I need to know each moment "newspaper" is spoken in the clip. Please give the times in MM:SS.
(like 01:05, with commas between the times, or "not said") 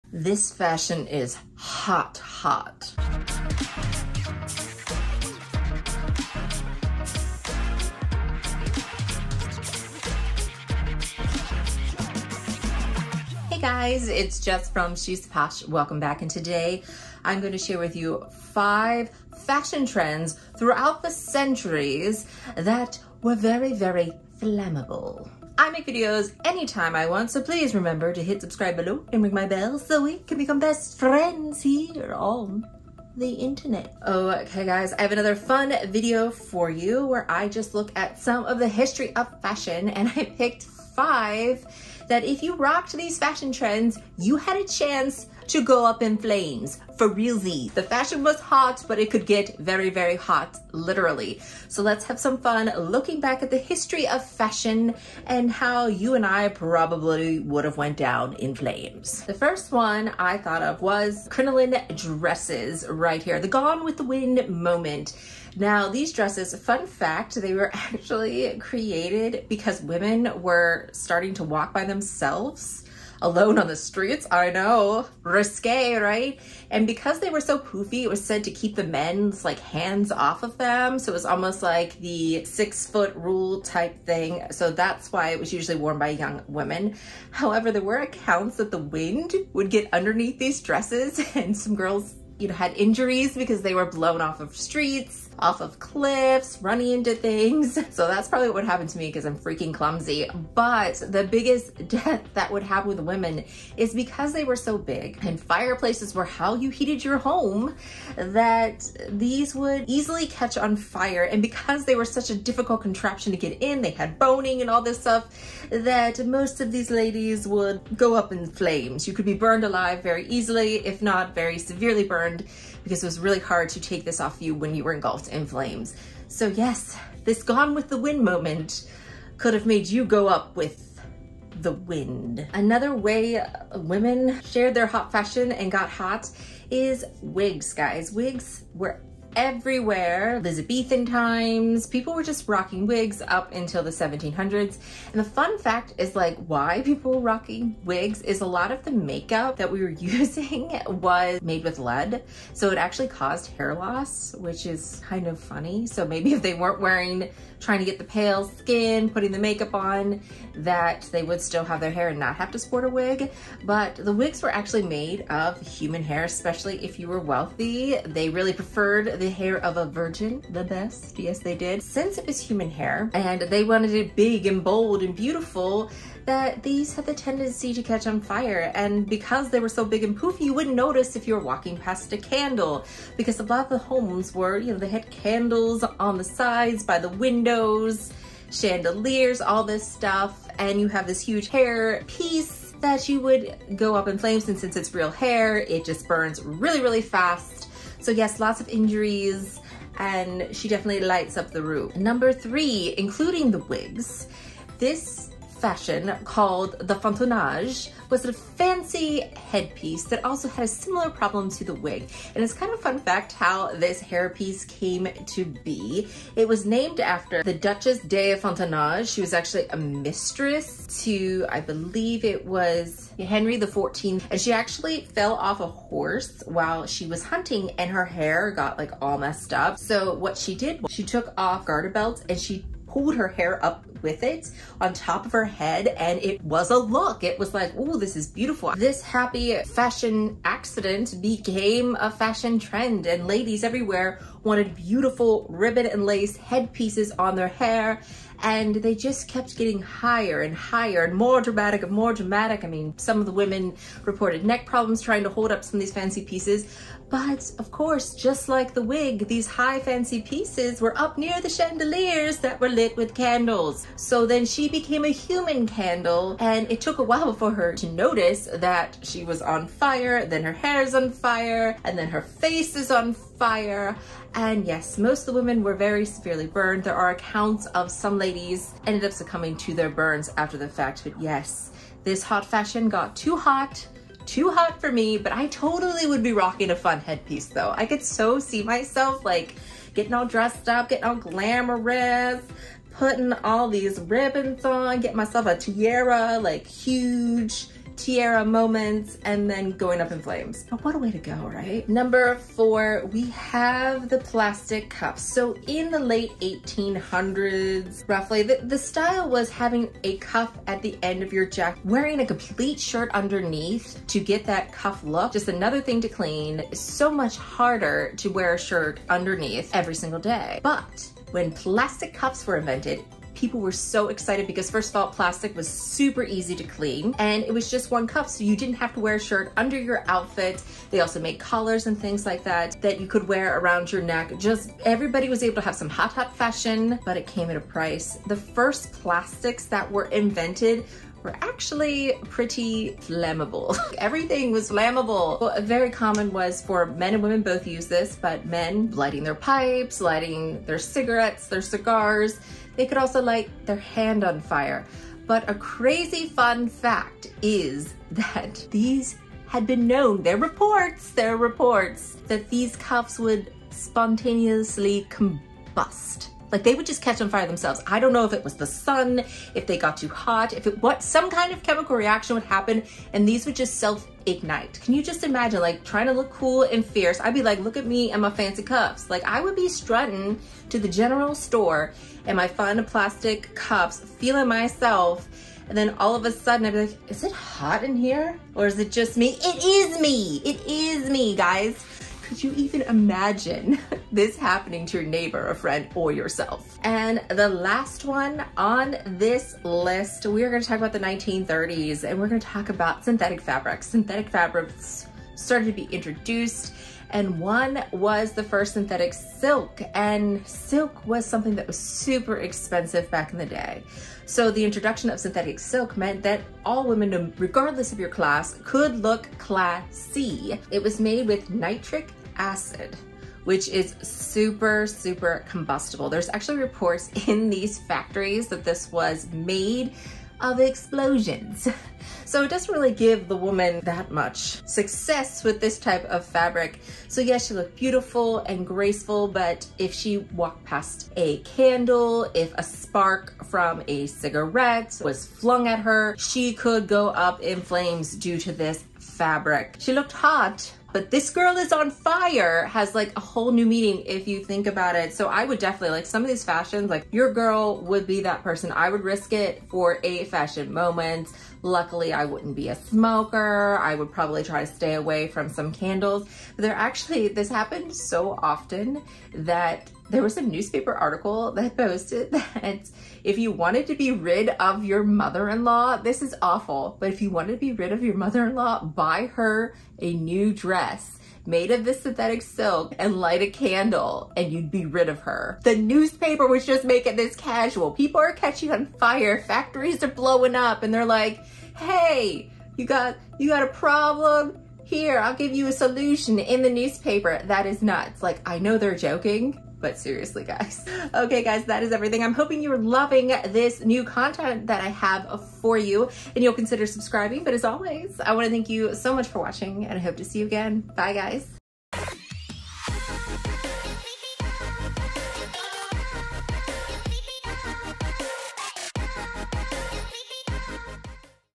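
07:50, 08:05, 08:16.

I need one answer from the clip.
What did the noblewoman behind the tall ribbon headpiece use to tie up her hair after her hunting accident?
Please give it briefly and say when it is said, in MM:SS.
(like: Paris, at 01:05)
Garter belts, at 03:51.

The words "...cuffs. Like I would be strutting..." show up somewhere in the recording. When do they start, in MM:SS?
06:18.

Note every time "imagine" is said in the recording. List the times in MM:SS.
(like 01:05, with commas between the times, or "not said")
06:15, 06:32.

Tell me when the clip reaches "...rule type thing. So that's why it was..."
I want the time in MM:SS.
01:23.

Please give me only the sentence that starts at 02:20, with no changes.
Elizabethan times, people were just rocking wigs up until the 1700s.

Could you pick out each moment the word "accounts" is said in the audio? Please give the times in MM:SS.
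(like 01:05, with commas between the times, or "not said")
01:27, 04:37.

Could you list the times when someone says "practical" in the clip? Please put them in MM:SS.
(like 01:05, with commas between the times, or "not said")
not said.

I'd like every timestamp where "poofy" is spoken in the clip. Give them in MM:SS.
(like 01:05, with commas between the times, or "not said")
01:17, 03:00.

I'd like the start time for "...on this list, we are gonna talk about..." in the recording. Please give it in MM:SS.
06:38.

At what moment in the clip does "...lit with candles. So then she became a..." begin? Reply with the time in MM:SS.
04:22.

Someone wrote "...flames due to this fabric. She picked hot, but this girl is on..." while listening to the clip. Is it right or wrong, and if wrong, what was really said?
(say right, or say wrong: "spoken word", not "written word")
wrong: "looked", not "picked".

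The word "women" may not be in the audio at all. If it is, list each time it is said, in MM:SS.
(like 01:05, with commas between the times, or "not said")
01:09, 01:26, 01:42, 02:13, 04:13, 04:35, 05:47, 06:56.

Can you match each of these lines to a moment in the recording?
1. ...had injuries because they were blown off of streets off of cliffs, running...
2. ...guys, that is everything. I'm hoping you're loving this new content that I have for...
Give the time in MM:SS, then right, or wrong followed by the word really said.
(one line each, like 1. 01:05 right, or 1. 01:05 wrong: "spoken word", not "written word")
1. 01:32 right
2. 08:21 right.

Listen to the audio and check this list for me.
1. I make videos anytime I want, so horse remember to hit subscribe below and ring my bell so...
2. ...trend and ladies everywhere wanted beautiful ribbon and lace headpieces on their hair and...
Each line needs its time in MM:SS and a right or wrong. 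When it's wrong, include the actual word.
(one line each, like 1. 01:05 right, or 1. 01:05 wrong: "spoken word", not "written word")
1. 00:25 wrong: "please", not "horse"
2. 04:02 right.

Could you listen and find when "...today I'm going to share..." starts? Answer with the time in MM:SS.
00:16.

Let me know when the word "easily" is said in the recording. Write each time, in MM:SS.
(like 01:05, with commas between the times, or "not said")
01:49, 02:00.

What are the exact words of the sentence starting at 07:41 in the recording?
Luckily, I wouldn't be a smoker.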